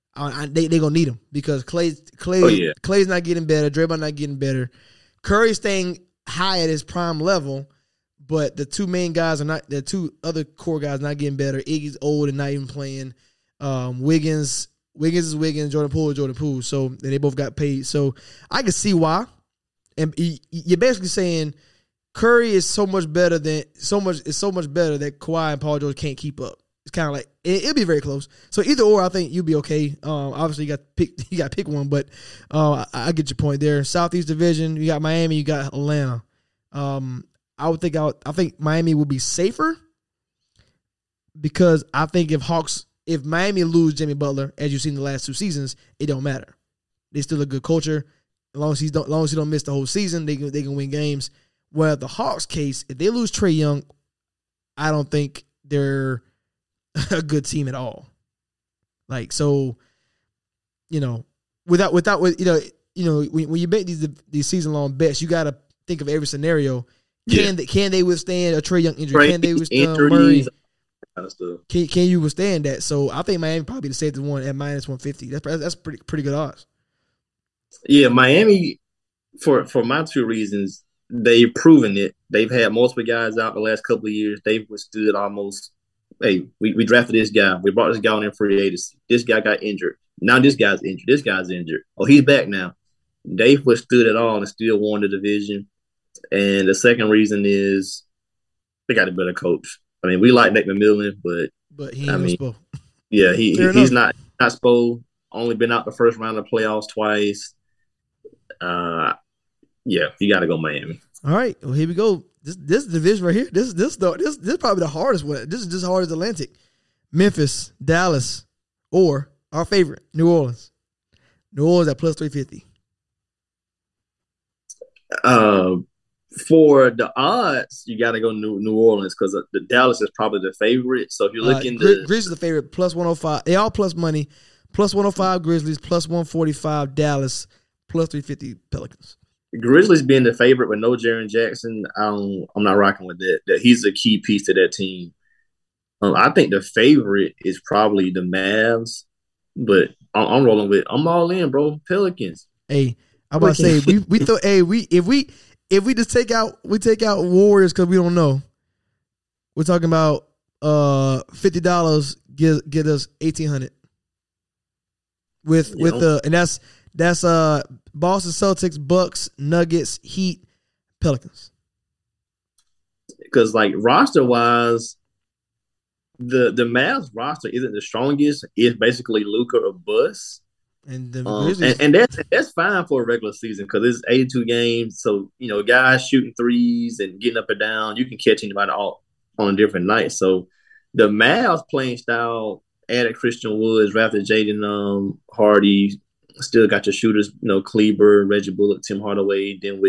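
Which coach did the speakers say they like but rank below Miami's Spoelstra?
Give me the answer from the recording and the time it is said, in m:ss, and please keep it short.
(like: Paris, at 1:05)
Nick McMillan, at 1:40.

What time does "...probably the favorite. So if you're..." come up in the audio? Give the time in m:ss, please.
2:10.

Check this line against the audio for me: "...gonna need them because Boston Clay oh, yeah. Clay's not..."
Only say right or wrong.
wrong.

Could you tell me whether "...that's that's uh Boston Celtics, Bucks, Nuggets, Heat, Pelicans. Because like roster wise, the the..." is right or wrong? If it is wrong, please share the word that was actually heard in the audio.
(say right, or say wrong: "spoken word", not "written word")
right.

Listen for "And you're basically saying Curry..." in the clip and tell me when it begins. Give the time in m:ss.
0:19.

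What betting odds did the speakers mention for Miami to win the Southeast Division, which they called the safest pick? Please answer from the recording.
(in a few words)
-150.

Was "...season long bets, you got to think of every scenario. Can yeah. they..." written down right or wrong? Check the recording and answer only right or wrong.
right.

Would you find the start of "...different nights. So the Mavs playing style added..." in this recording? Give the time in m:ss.
3:09.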